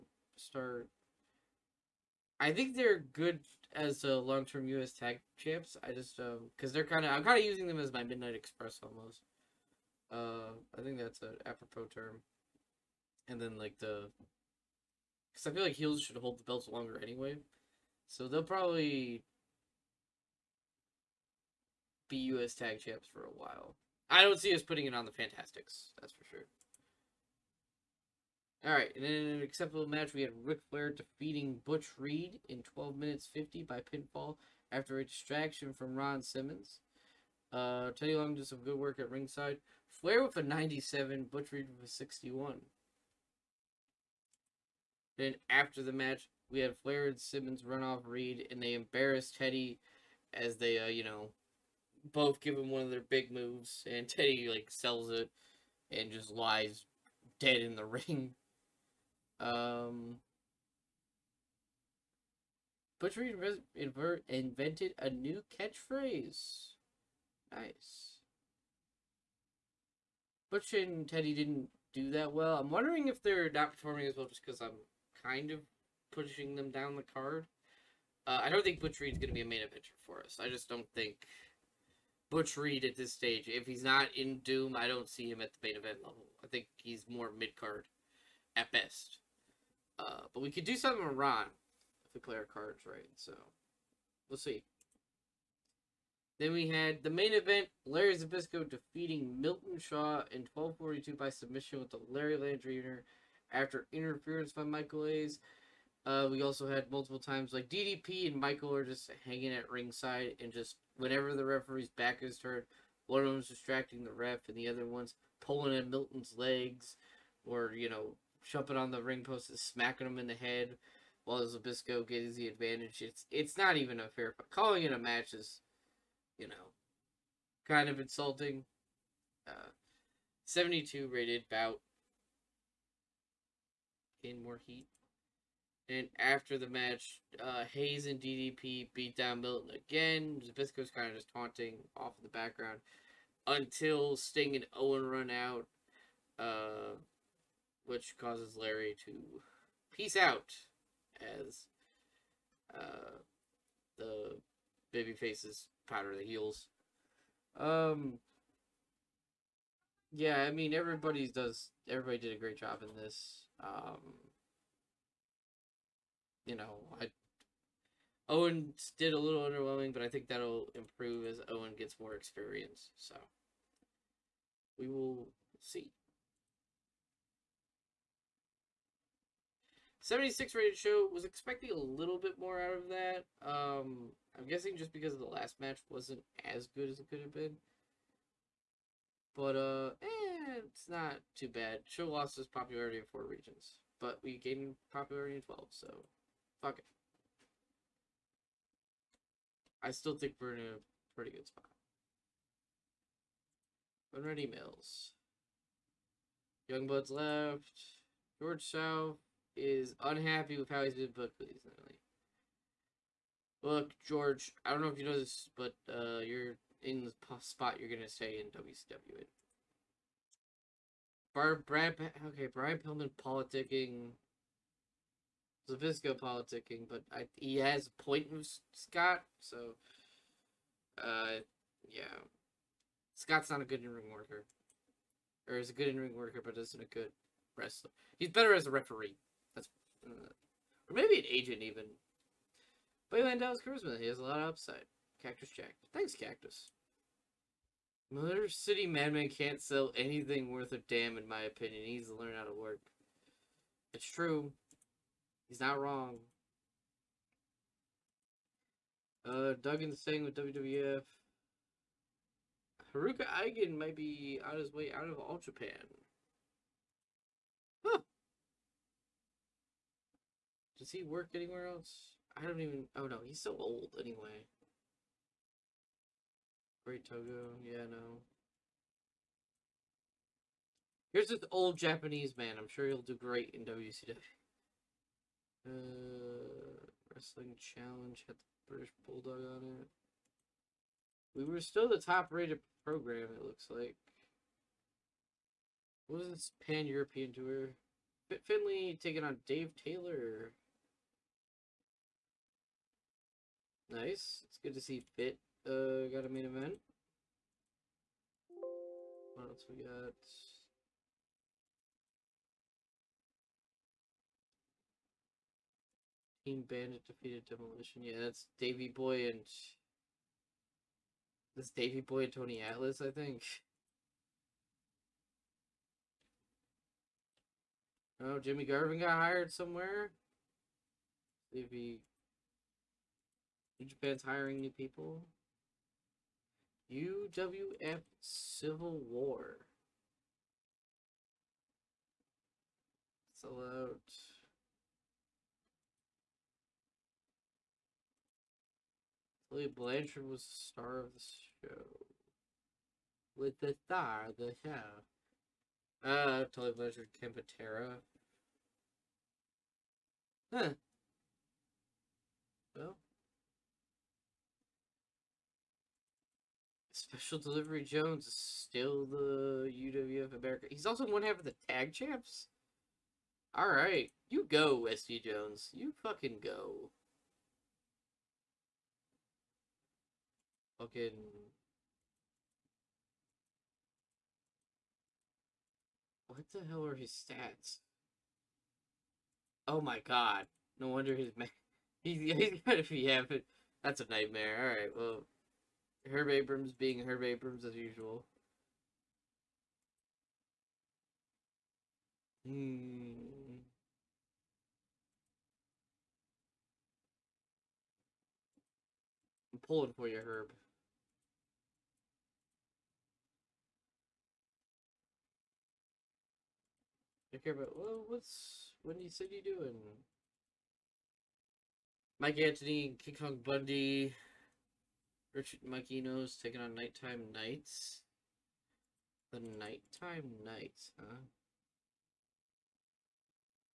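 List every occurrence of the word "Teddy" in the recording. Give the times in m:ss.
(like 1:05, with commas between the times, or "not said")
0:37, 0:49, 0:54, 1:11.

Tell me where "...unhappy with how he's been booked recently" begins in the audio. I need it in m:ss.
3:30.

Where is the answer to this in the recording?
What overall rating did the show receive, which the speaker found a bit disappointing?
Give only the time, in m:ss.
3:00.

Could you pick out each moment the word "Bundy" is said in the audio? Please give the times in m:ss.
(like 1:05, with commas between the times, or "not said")
7:03.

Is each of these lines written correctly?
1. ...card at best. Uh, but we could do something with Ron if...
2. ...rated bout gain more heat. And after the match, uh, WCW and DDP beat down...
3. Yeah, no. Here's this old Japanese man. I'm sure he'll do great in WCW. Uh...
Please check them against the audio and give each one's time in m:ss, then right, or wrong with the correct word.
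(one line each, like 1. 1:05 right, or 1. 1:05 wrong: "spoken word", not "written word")
1. 1:27 right
2. 2:11 wrong: "Hayes", not "WCW"
3. 4:37 right.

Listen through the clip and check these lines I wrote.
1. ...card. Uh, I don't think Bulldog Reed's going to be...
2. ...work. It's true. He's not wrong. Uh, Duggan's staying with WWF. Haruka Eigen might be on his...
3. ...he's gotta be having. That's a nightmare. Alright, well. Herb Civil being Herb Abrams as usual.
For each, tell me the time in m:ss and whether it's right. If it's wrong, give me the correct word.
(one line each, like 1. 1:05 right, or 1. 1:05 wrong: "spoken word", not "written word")
1. 1:17 wrong: "Butch", not "Bulldog"
2. 4:12 right
3. 6:32 wrong: "Abrams", not "Civil".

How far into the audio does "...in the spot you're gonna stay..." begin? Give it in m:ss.
3:36.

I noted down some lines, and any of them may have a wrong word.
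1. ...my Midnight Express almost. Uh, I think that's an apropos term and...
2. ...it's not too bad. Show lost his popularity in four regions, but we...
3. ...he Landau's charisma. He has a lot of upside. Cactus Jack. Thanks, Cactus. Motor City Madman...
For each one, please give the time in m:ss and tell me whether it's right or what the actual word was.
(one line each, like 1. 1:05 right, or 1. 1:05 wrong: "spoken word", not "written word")
1. 0:07 right
2. 3:10 right
3. 4:03 right.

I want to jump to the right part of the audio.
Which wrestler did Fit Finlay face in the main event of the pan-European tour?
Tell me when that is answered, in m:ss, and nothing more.
4:59.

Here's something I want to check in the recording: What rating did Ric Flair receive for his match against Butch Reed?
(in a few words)
97.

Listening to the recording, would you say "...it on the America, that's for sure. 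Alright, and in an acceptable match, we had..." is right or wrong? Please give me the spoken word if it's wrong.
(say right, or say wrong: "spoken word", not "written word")
wrong: "Fantastics", not "America".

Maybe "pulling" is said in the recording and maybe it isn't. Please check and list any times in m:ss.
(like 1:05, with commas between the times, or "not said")
1:55, 6:49.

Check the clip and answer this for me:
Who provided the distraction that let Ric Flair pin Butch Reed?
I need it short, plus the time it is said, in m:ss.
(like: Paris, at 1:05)
Ron Simmons, at 0:35.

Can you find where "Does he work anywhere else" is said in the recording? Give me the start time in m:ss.
4:30.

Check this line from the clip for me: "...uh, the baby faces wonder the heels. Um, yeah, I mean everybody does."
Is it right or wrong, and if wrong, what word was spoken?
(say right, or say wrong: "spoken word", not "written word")
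wrong: "powder", not "wonder".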